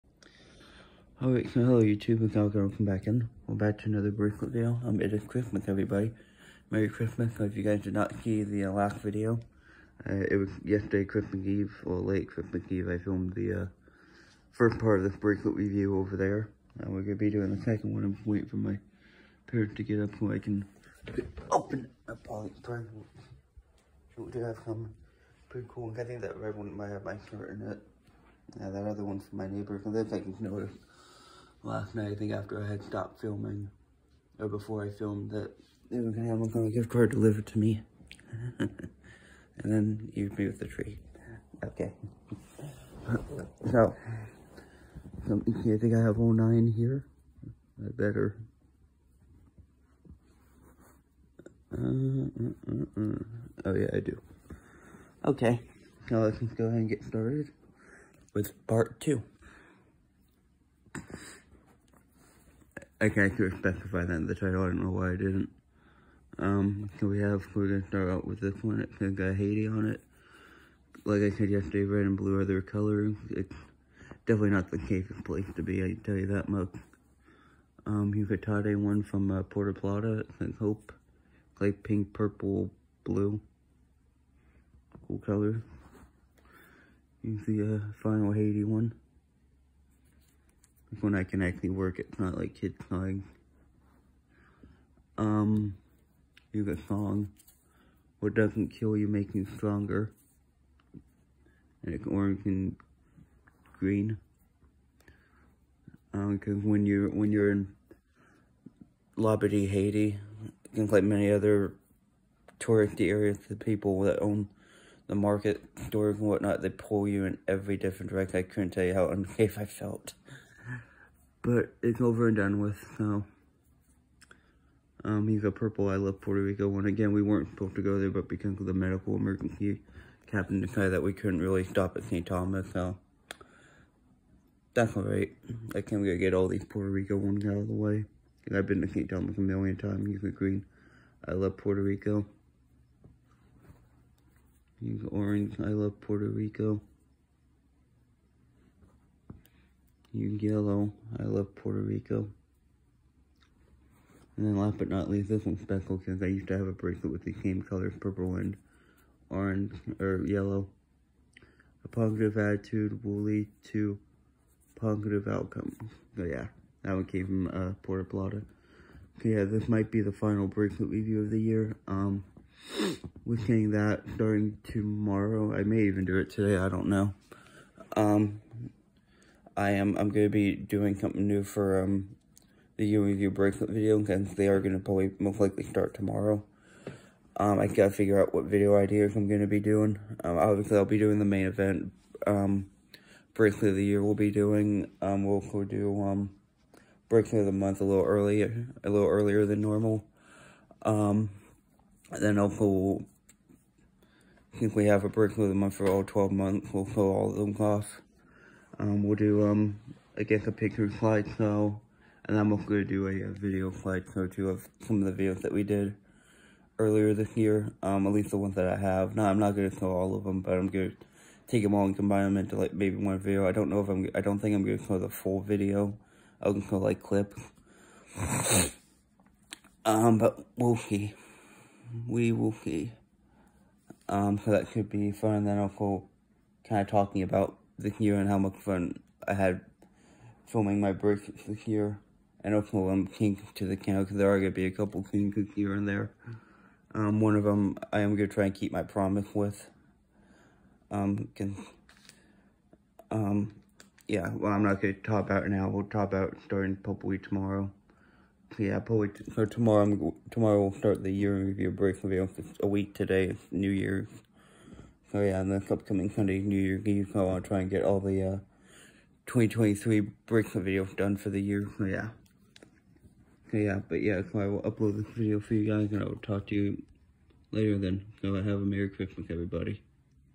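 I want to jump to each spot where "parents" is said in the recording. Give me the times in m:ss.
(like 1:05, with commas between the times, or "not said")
0:19.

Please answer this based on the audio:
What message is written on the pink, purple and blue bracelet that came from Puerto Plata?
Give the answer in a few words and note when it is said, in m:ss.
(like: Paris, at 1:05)
Hope, at 1:20.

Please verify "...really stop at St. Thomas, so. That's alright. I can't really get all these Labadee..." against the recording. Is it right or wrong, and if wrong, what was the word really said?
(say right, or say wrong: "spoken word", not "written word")
wrong: "Puerto", not "Labadee".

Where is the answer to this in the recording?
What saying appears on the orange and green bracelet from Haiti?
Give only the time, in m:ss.
1:38.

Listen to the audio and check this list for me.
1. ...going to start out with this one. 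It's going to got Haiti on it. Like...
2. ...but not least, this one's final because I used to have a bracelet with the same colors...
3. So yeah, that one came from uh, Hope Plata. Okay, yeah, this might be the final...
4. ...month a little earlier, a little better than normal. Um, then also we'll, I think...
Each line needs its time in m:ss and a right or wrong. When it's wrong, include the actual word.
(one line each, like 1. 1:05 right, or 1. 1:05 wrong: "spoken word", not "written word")
1. 1:07 right
2. 2:34 wrong: "special", not "final"
3. 2:46 wrong: "Puerto", not "Hope"
4. 3:17 wrong: "earlier", not "better".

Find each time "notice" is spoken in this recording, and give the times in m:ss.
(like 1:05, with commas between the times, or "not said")
0:30.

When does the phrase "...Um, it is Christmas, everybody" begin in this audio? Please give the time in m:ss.
0:04.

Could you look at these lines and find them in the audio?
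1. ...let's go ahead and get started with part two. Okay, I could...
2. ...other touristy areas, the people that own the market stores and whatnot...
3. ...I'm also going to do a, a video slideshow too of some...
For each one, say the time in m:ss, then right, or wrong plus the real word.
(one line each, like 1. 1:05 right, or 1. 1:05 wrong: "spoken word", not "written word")
1. 0:56 right
2. 1:51 right
3. 3:32 right.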